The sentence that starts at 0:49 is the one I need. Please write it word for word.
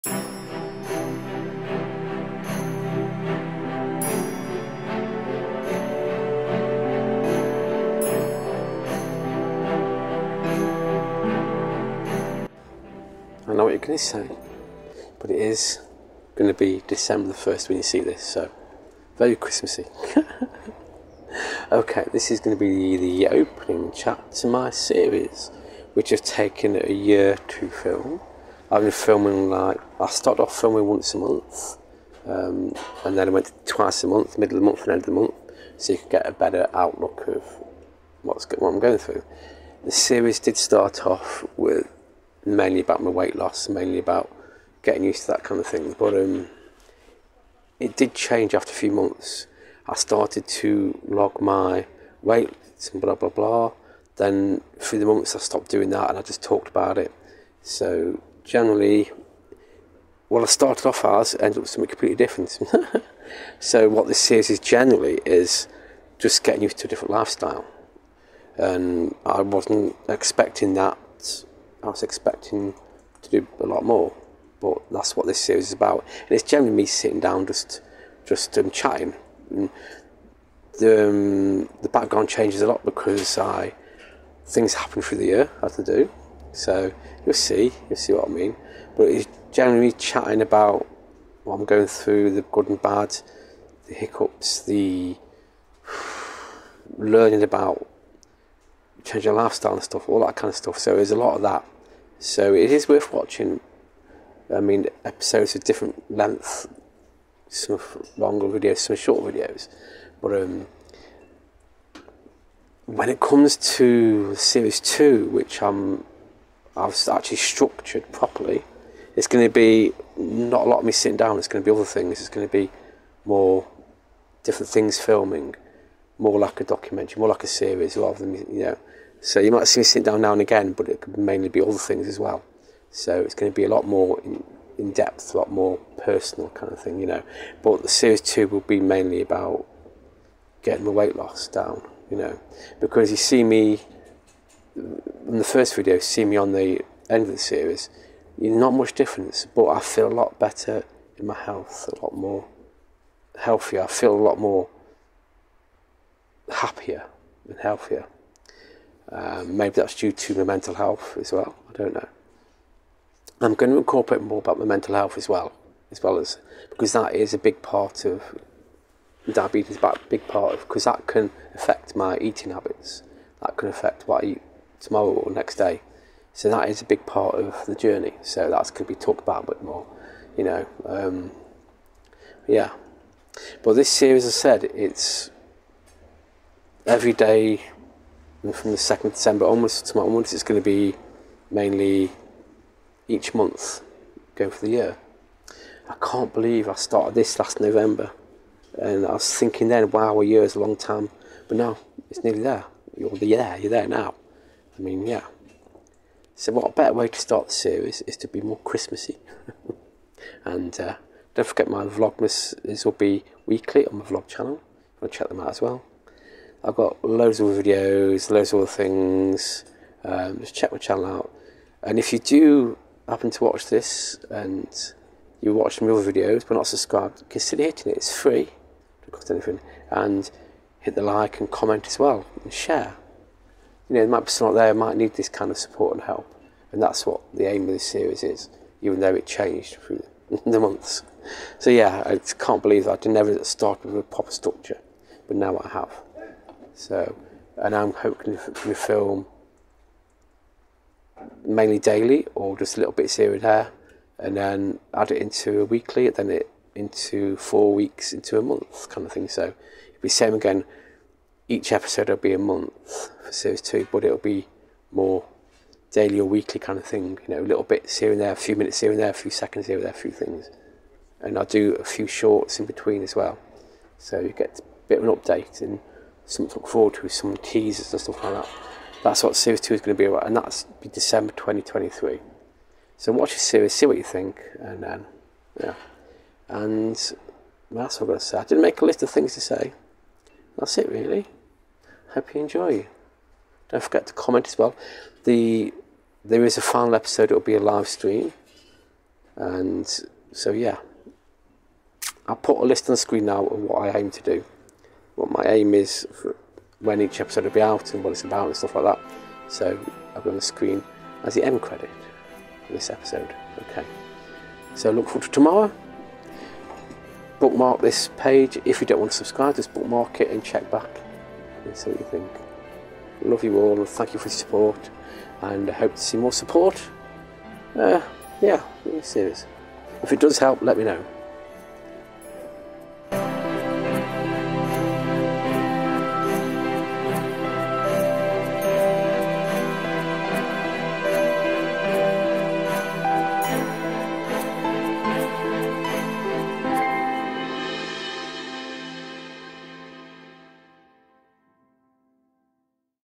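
I started to log my weight and blah blah blah.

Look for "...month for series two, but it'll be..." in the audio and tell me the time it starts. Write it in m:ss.
4:22.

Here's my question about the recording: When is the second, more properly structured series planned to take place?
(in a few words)
December 2023.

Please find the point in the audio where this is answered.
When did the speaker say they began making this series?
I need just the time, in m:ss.
3:17.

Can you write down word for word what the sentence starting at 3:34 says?
You want to check them out as well.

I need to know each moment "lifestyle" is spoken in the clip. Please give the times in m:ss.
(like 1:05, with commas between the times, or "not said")
1:07, 1:39.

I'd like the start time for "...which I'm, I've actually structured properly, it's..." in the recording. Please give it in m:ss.
1:55.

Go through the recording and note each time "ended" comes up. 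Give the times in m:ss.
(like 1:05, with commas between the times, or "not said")
1:01.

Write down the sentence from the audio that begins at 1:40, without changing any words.
So there's a lot of that.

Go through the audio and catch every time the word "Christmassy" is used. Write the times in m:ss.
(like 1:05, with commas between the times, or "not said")
0:19, 3:28.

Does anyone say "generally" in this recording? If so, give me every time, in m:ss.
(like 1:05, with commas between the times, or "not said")
0:58, 1:04, 1:16, 1:29.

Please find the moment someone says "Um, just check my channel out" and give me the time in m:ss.
3:40.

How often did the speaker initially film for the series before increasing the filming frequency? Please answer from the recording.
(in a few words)
Once a month.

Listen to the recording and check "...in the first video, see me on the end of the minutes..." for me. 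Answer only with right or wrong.
wrong.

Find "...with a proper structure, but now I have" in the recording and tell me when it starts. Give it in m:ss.
4:03.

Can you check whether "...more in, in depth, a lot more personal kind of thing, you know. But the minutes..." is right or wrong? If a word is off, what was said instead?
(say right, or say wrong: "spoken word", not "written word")
wrong: "series", not "minutes".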